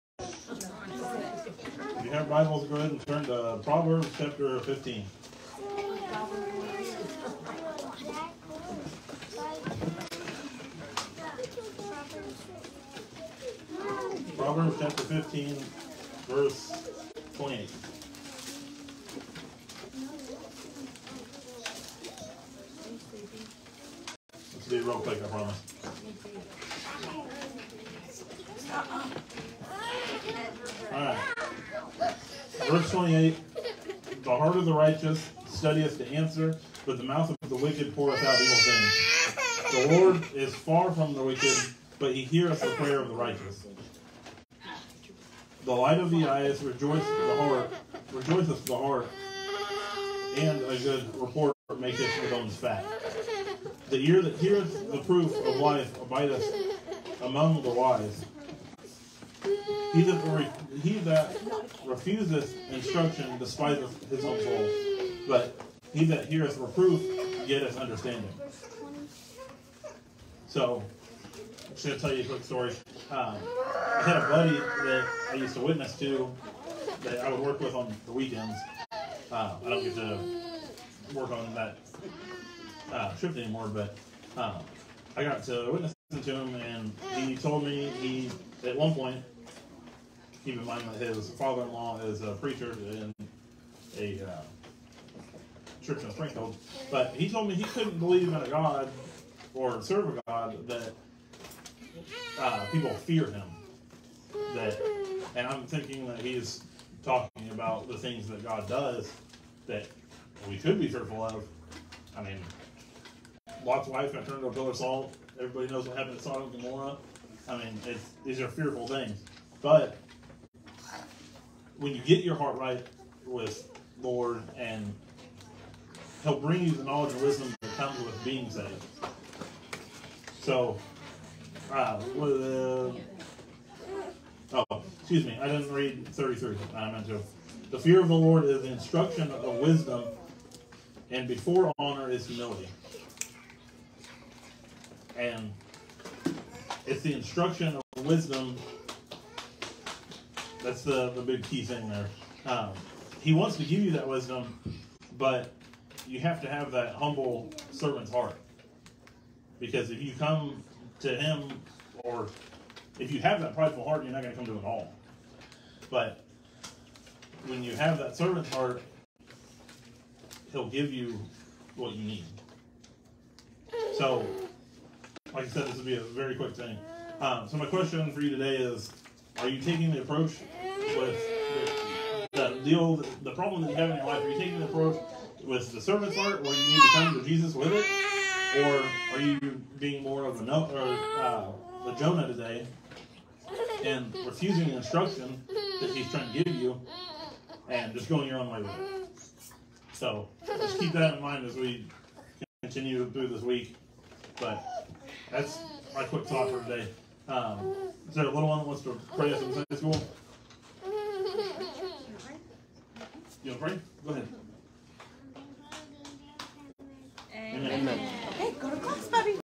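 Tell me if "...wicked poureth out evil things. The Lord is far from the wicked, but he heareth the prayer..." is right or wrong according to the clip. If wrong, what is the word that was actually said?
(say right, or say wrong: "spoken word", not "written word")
right.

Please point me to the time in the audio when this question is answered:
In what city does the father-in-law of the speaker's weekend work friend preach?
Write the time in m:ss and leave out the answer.
1:36.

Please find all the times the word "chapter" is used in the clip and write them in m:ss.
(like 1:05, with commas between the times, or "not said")
0:04, 0:14.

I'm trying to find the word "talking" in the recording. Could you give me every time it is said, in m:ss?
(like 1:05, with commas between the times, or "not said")
1:47.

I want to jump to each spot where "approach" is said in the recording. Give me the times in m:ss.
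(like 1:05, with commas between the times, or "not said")
3:00, 3:04.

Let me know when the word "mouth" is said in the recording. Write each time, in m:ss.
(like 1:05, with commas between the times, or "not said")
0:37.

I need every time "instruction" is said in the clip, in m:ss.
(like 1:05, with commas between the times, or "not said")
1:02, 2:18, 2:27, 3:14.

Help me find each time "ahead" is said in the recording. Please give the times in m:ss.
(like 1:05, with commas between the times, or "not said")
0:02, 3:34.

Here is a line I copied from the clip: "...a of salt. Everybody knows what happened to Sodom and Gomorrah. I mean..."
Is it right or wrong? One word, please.
right.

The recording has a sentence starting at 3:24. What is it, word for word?
But that's my quick thought for today.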